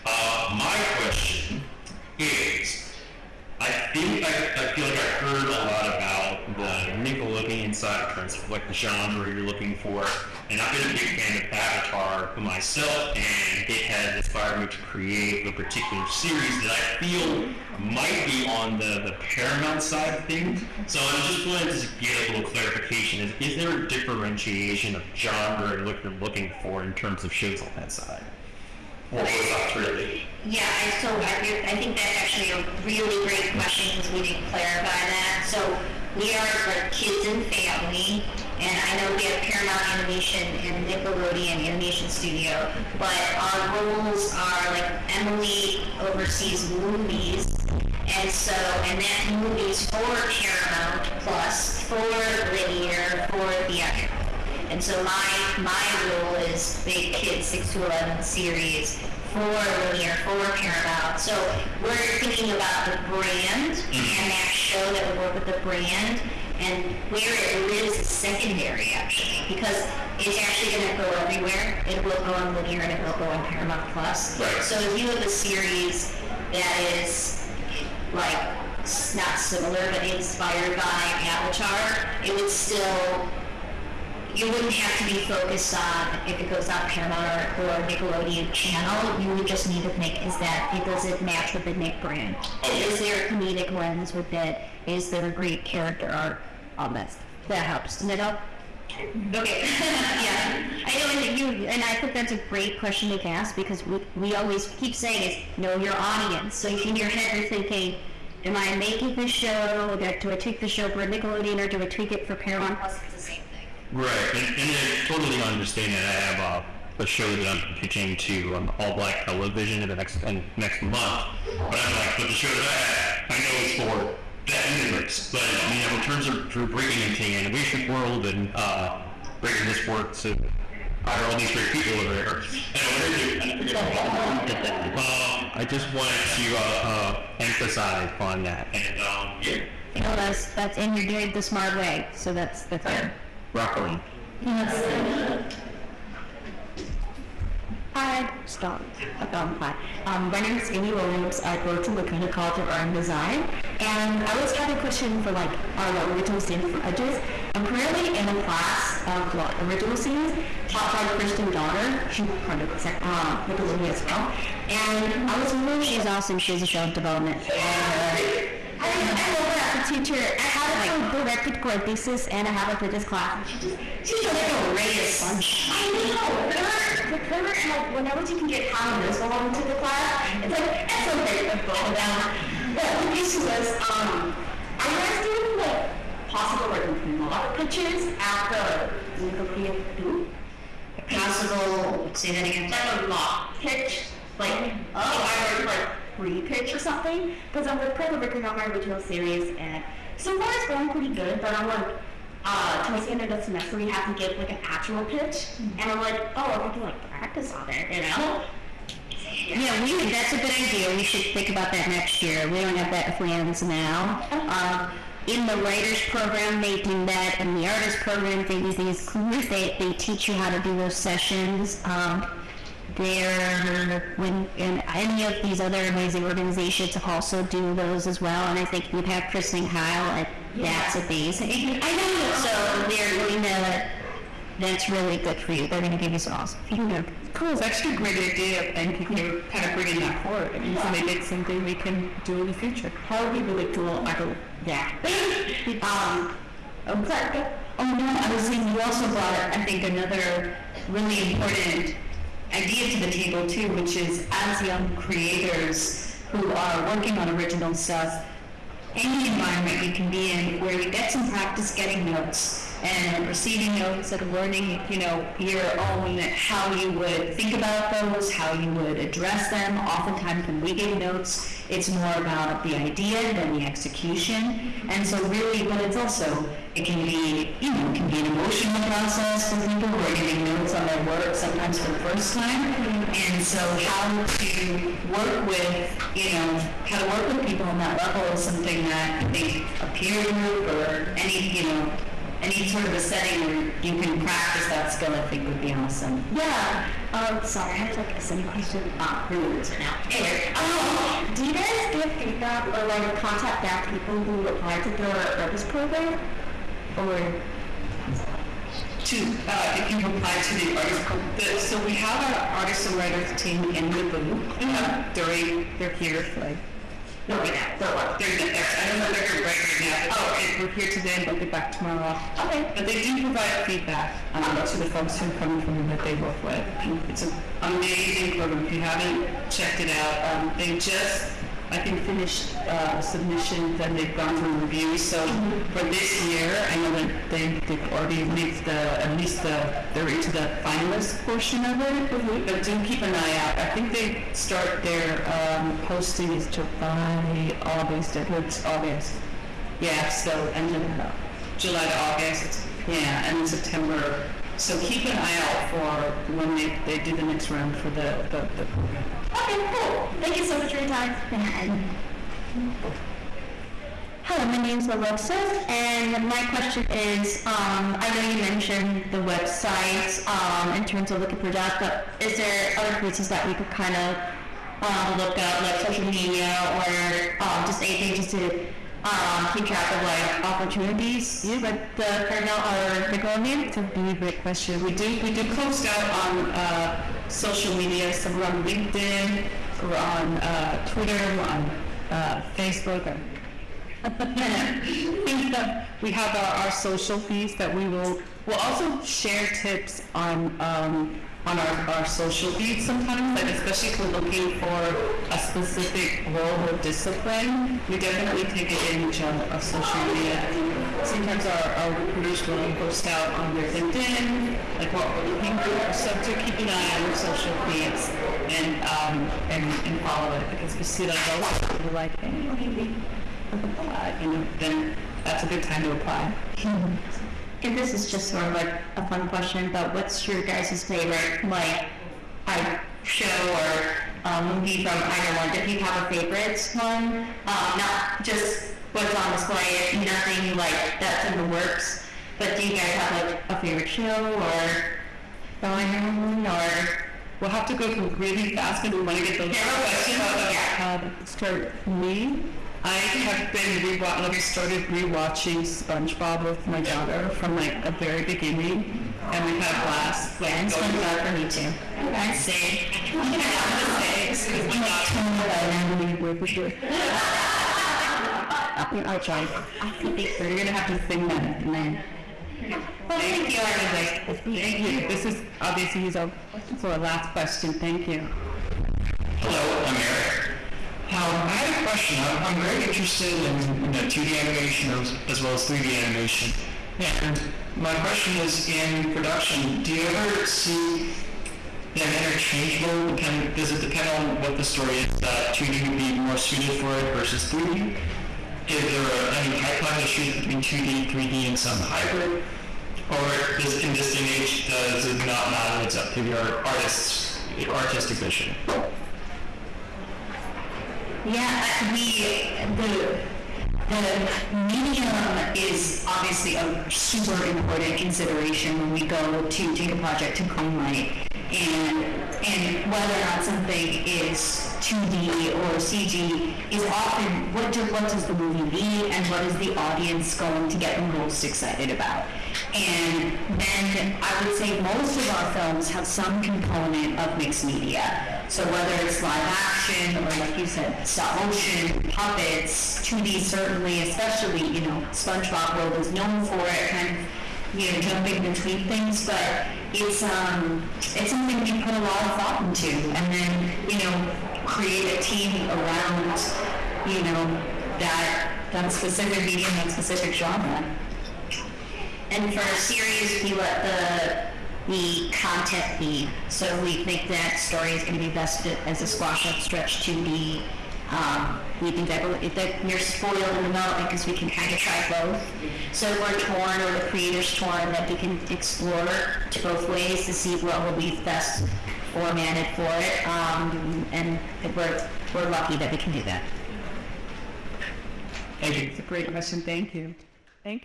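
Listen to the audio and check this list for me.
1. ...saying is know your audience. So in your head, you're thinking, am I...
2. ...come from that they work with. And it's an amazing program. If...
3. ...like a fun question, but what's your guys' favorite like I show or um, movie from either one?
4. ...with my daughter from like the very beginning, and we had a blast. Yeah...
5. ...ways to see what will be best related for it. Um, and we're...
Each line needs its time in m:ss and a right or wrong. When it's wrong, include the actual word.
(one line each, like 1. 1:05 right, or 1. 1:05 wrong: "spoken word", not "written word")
1. 1:44 right
2. 5:25 right
3. 7:08 right
4. 7:36 right
5. 9:39 wrong: "formatted", not "related".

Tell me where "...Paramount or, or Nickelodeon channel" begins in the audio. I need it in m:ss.
1:26.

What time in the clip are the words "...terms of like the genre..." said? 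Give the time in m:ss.
0:08.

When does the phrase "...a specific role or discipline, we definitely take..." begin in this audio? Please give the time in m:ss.
6:45.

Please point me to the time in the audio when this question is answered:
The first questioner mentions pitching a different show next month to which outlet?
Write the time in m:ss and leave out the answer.
1:58.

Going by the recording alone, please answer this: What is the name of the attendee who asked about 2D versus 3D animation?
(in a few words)
Eric.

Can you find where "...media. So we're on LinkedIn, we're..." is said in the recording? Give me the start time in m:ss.
6:27.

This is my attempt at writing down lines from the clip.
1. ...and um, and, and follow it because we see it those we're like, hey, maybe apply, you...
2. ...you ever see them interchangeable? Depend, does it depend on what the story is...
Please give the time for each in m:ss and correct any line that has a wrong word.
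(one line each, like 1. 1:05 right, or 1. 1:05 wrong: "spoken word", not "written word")
1. 6:58 right
2. 8:09 right.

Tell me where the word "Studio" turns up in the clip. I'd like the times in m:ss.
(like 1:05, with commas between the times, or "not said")
0:42.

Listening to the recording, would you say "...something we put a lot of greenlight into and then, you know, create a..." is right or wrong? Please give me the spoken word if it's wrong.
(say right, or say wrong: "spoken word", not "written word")
wrong: "thought", not "greenlight".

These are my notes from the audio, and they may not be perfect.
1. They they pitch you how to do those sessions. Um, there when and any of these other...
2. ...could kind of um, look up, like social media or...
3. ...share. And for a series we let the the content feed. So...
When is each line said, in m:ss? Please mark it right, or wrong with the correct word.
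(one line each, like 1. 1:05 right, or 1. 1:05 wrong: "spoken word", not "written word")
1. 3:39 wrong: "teach", not "pitch"
2. 6:13 right
3. 9:20 wrong: "genre", not "share".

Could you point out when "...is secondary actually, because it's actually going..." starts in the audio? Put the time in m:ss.
1:07.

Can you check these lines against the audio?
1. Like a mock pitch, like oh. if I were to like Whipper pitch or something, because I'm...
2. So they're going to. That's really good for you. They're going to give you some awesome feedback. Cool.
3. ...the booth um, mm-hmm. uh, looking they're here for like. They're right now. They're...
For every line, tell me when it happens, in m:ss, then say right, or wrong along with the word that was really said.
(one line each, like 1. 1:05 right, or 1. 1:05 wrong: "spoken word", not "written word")
1. 3:12 wrong: "Pre", not "Whipper"
2. 3:52 right
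3. 5:13 wrong: "during", not "looking".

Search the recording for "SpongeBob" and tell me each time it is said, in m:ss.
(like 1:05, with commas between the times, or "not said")
7:35, 7:40, 9:05.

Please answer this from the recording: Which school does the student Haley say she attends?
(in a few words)
Laguna College of Art and Design.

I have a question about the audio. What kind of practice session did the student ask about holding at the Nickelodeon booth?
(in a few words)
mock pitch.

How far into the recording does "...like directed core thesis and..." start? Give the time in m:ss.
2:50.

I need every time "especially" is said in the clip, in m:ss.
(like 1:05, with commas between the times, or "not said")
6:43, 9:04.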